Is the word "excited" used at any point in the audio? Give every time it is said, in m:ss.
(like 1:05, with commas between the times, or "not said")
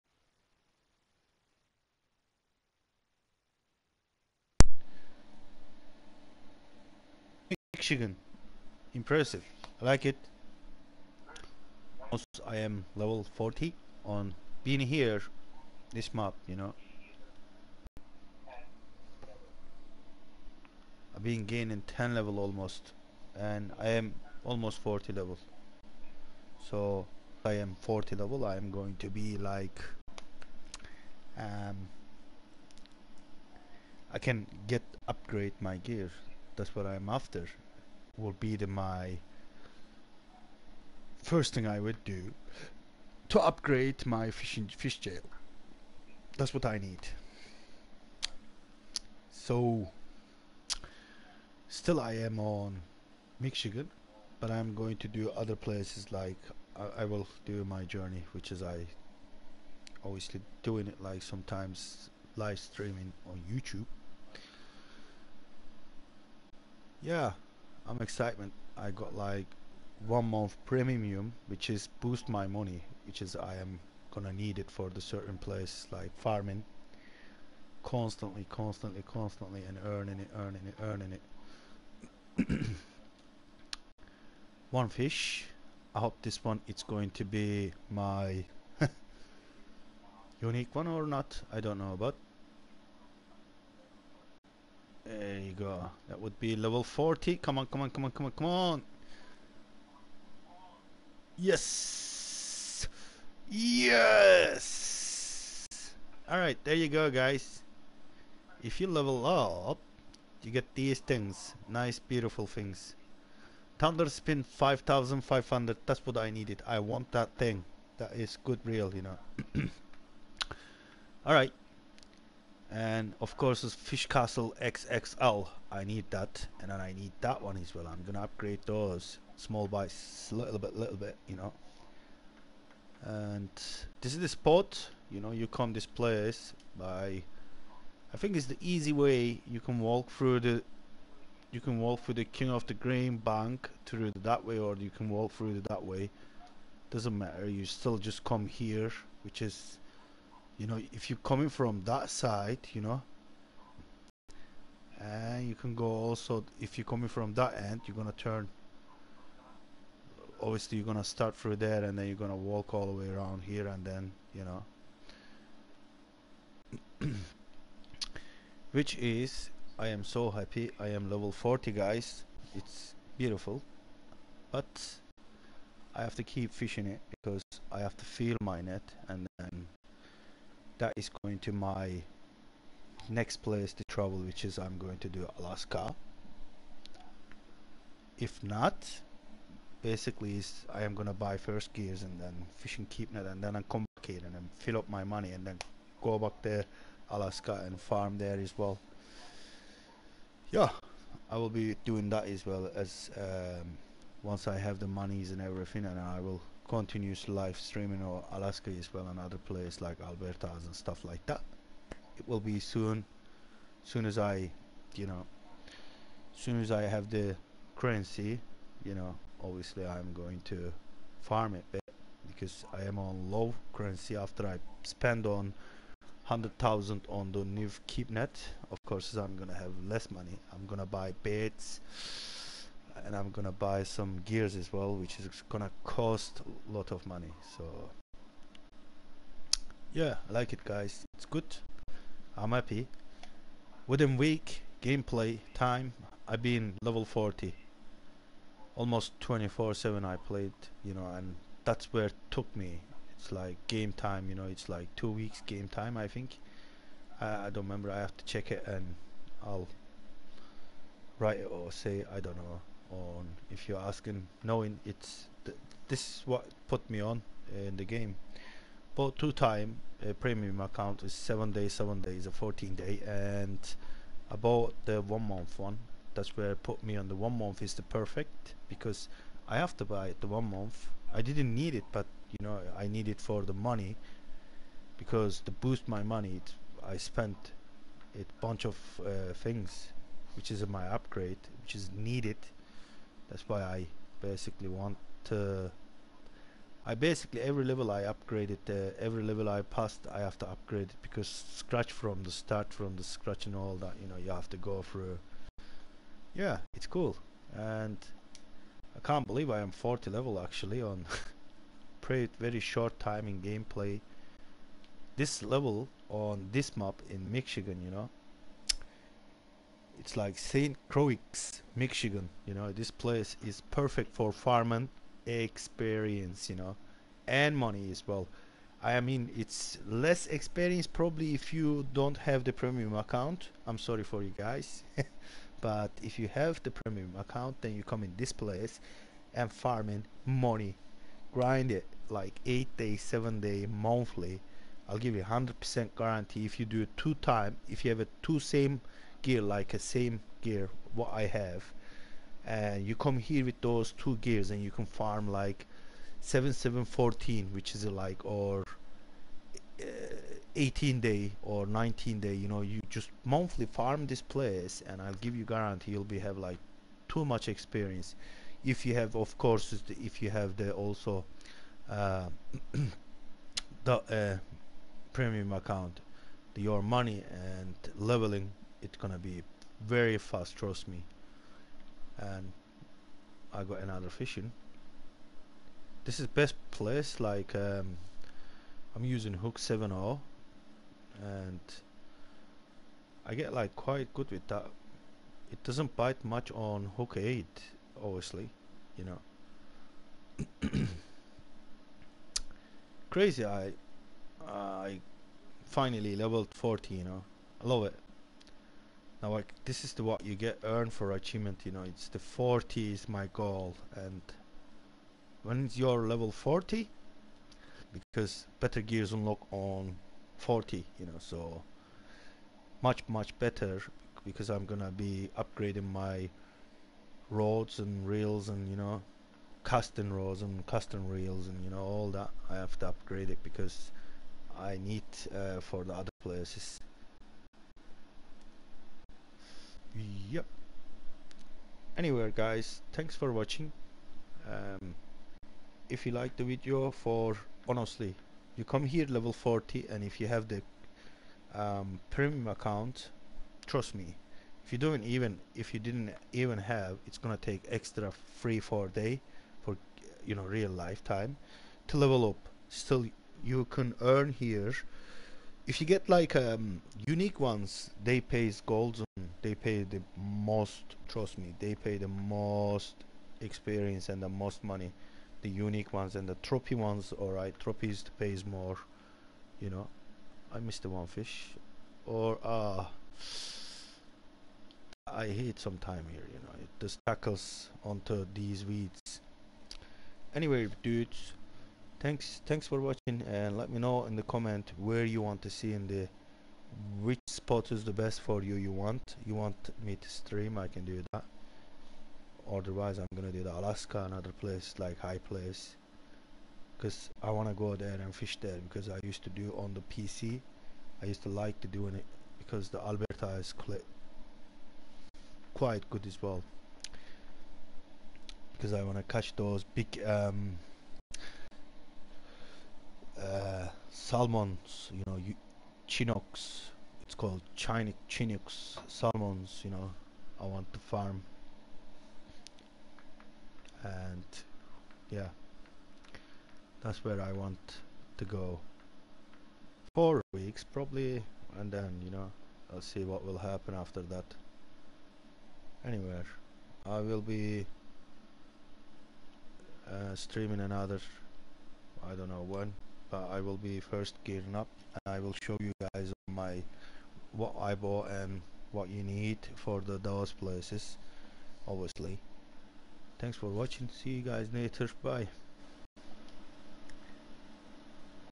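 1:07.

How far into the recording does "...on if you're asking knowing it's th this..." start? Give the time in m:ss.
4:22.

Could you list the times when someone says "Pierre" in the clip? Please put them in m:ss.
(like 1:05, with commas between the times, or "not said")
not said.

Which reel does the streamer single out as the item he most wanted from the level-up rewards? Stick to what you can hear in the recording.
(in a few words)
Thunder Spin 5500.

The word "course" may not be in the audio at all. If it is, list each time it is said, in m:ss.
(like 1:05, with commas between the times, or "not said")
2:03, 3:48, 6:09.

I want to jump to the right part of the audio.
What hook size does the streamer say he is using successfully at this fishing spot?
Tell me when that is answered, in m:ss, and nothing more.
6:29.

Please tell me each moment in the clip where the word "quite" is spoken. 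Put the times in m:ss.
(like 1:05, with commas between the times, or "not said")
6:33, 8:35.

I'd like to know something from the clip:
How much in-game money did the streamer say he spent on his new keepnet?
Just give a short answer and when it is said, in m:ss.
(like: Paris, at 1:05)
100,000, at 3:46.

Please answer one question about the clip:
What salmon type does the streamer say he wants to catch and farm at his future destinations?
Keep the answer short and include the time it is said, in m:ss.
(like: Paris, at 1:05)
Chinook, at 8:47.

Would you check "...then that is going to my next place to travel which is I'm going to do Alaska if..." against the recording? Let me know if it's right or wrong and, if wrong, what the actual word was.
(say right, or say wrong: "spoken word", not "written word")
right.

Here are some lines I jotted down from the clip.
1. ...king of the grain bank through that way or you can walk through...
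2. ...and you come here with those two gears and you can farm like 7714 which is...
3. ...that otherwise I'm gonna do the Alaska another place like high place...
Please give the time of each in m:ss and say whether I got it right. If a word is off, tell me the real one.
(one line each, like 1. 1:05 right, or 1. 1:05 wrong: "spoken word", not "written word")
1. 2:22 right
2. 5:52 right
3. 8:21 right.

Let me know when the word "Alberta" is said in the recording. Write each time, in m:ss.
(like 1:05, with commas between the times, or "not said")
3:30, 8:32.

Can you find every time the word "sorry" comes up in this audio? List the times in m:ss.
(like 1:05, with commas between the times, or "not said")
5:33.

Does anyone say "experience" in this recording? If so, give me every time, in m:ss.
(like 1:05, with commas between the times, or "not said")
5:25, 5:30, 6:07, 7:53.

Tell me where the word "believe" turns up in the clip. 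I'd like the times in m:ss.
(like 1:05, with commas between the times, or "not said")
5:09.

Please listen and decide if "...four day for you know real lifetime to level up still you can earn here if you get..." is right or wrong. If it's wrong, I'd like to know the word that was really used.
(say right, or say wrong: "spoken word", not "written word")
right.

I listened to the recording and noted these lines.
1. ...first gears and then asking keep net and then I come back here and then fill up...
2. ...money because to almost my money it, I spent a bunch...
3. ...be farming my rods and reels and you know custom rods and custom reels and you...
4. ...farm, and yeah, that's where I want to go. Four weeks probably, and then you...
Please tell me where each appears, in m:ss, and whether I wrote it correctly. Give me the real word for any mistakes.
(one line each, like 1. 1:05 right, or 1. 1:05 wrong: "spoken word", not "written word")
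1. 3:11 wrong: "fishing", not "asking"
2. 4:43 wrong: "boost", not "almost"
3. 7:04 wrong: "upgrading", not "farming"
4. 8:50 right.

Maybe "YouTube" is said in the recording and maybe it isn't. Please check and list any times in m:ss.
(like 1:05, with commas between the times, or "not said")
1:03.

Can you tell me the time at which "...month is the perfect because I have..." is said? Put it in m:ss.
4:37.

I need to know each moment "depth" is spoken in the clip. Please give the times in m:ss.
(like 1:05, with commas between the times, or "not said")
not said.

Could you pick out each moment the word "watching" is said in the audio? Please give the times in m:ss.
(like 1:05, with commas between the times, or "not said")
7:23, 8:12, 9:23.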